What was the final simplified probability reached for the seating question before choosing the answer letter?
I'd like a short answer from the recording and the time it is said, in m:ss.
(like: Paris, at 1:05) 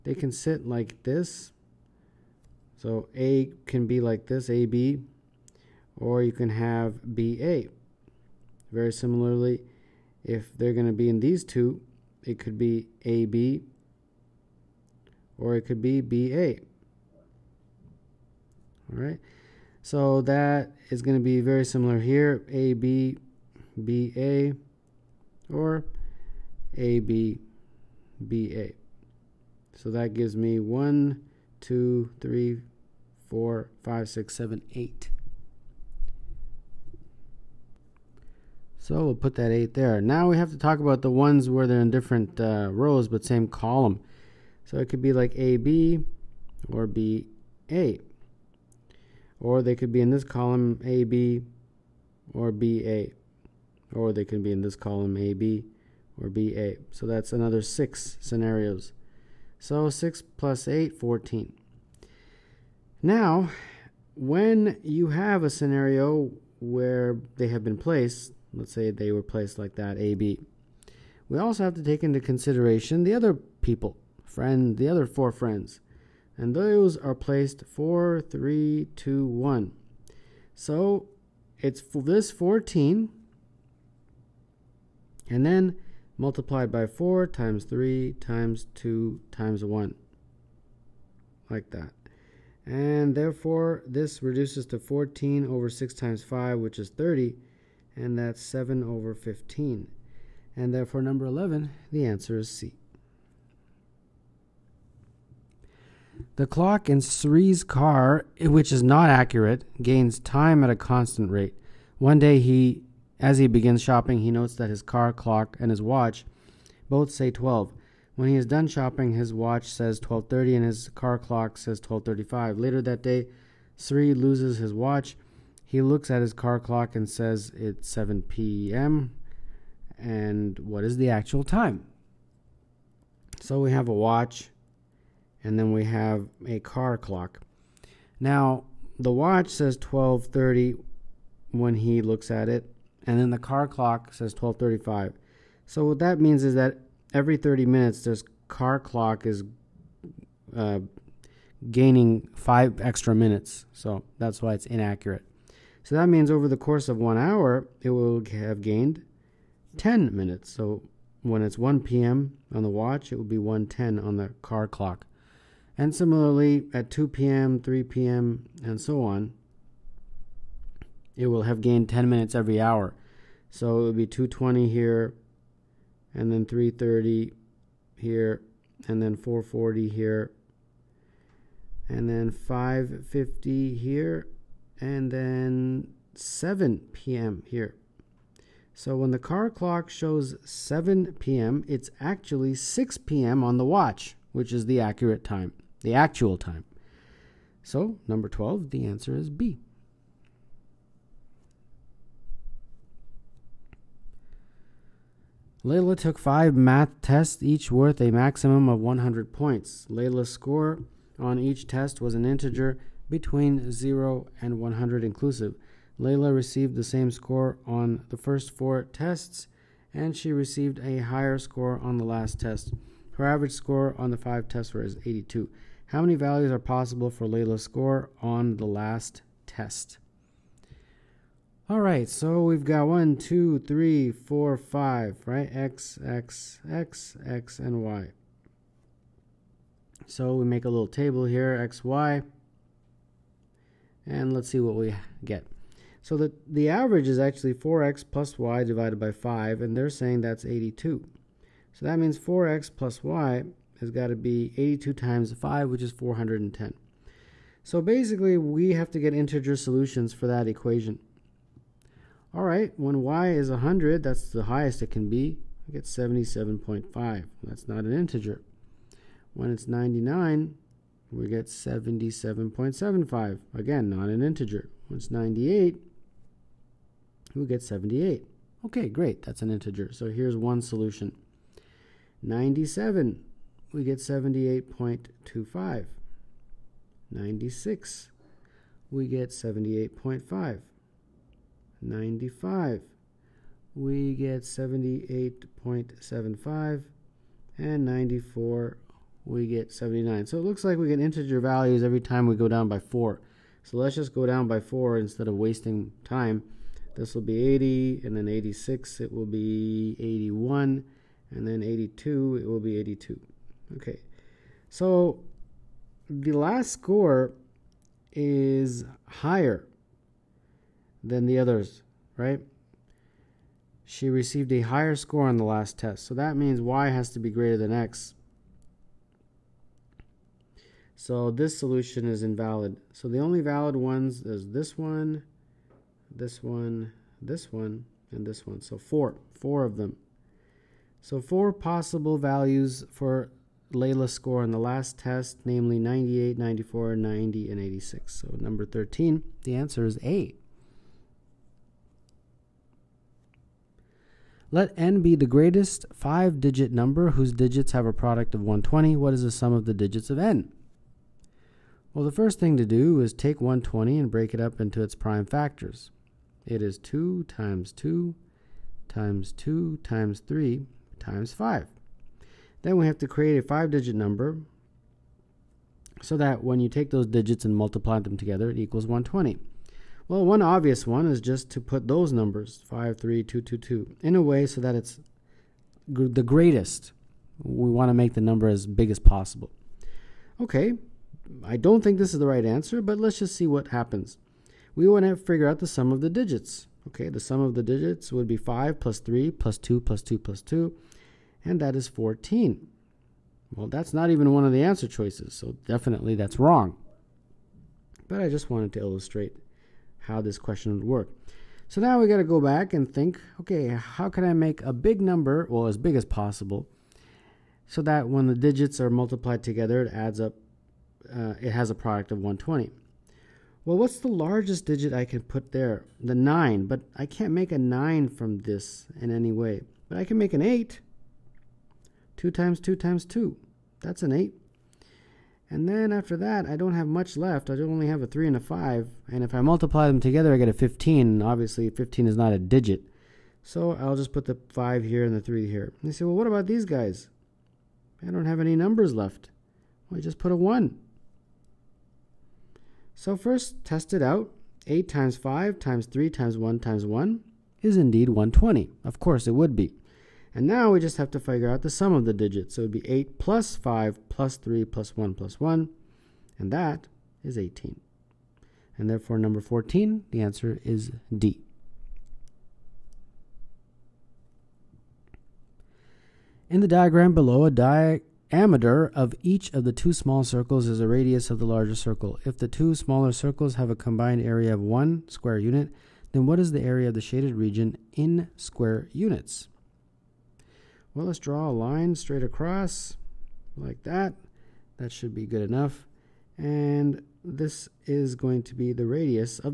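7/15, at 1:38.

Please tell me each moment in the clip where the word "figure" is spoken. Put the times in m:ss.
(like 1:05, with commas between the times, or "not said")
6:35, 7:41.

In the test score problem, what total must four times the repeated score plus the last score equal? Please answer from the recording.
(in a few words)
410.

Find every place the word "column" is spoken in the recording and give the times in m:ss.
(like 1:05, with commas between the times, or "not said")
0:43, 0:50, 0:54.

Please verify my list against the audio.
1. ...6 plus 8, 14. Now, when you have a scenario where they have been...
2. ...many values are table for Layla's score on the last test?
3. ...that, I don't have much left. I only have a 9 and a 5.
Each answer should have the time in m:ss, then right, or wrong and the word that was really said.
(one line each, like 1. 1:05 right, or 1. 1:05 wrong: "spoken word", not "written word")
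1. 0:59 right
2. 3:46 wrong: "possible", not "table"
3. 7:16 wrong: "3", not "9".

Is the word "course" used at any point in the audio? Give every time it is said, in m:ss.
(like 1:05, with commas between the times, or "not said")
2:36, 7:38.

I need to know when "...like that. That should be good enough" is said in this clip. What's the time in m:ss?
8:13.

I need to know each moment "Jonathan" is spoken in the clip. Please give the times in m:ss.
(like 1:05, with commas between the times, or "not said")
not said.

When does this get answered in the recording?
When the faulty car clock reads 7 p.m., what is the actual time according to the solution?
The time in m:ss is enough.
3:12.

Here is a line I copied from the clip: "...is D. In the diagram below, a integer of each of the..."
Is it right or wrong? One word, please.
wrong.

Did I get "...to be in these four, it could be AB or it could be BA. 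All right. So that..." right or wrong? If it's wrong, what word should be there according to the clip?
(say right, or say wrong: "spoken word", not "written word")
wrong: "two", not "four".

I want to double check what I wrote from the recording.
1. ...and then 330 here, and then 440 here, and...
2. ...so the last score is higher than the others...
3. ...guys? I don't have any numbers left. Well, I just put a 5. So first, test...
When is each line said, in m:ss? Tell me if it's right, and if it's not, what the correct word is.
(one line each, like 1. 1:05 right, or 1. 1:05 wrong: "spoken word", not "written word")
1. 2:56 right
2. 5:14 right
3. 7:26 wrong: "1", not "5".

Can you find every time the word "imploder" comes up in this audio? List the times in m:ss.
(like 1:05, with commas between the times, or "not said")
not said.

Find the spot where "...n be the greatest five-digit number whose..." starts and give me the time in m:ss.
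5:54.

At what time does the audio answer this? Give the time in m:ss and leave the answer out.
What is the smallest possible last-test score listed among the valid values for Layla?
5:47.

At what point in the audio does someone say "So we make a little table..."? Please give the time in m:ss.
4:00.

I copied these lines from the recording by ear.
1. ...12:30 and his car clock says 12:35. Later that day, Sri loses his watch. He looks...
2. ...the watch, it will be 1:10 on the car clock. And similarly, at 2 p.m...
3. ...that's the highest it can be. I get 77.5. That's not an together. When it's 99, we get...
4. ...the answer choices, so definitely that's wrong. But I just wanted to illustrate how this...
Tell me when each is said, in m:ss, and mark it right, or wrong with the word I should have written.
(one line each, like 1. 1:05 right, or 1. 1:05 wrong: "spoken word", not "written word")
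1. 1:59 right
2. 2:42 right
3. 4:24 wrong: "integer", not "together"
4. 6:44 right.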